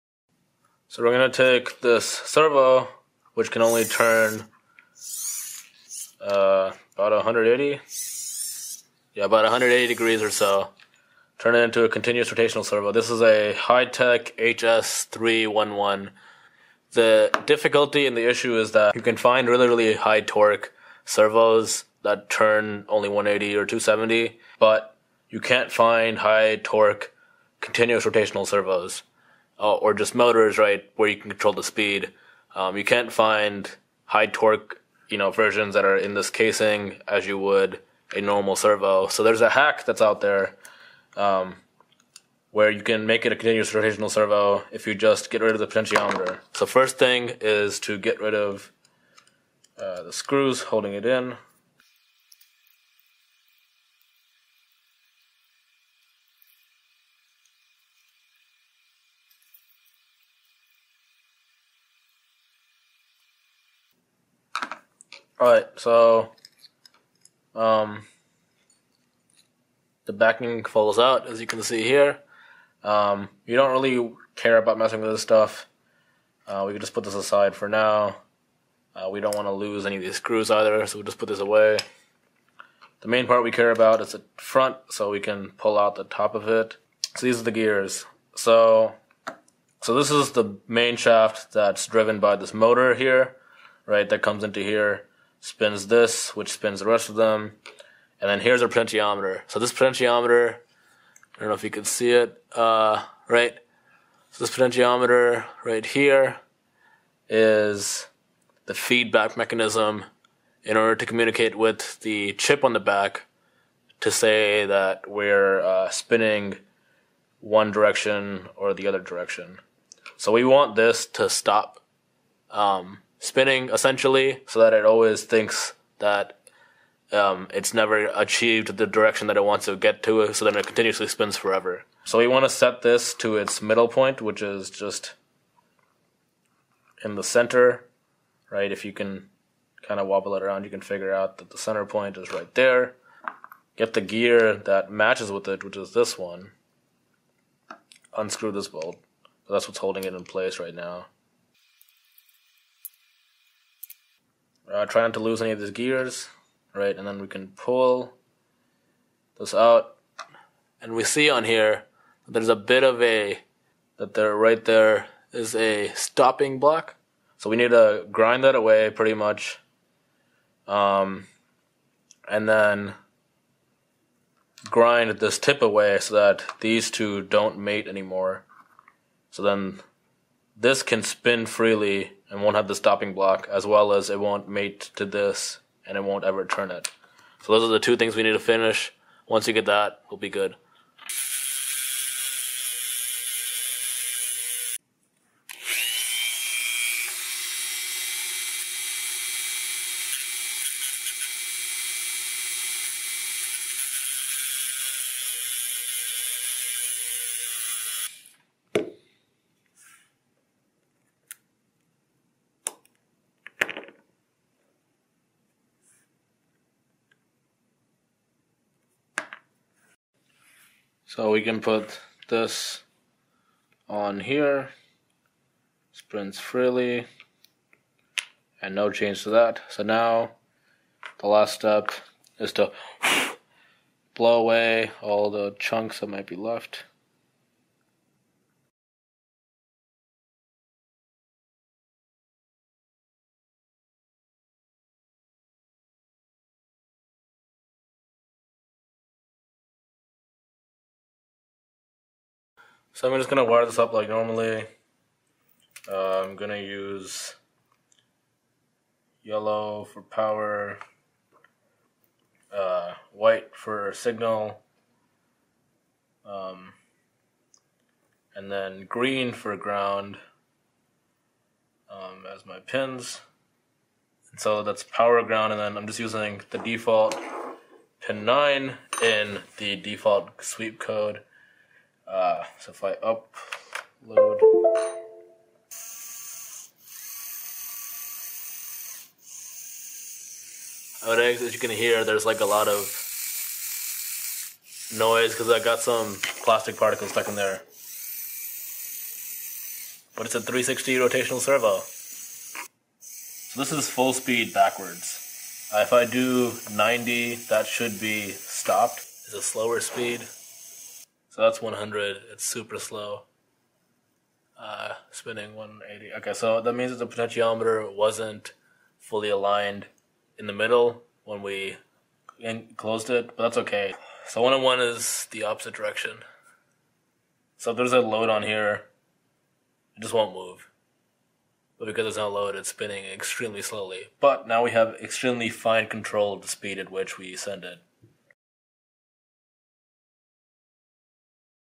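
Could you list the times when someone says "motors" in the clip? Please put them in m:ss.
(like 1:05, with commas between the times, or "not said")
0:30, 1:32.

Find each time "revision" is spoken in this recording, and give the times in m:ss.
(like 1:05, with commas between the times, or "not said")
not said.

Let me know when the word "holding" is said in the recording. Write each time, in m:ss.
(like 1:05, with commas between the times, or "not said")
0:50, 2:29.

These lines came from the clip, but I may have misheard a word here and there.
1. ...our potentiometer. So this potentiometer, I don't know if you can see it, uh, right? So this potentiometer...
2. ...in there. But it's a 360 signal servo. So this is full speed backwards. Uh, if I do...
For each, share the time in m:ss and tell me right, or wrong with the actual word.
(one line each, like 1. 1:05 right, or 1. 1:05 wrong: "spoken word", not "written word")
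1. 1:38 right
2. 4:57 wrong: "rotational", not "signal".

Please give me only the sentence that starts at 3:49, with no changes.
So now the last step is to blow away all the chunks that might be left.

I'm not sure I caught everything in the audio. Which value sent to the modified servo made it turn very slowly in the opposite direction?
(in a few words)
101.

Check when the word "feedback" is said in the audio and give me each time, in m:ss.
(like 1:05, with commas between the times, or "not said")
1:48.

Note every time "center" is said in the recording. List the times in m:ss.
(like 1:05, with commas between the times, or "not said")
2:17, 2:21.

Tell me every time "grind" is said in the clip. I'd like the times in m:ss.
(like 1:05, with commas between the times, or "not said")
2:48, 2:54.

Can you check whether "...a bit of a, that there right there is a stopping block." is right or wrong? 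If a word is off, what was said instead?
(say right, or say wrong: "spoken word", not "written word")
right.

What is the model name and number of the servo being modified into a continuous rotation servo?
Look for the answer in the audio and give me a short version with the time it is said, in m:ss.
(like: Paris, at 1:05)
Hitec HS311, at 0:13.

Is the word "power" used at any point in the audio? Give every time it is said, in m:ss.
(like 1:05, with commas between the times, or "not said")
4:20, 4:34.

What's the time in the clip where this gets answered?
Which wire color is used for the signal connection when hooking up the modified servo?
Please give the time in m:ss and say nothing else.
4:23.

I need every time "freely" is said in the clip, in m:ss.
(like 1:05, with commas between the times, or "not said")
3:01, 3:46.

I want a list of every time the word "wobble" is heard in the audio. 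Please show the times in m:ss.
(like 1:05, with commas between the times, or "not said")
2:20.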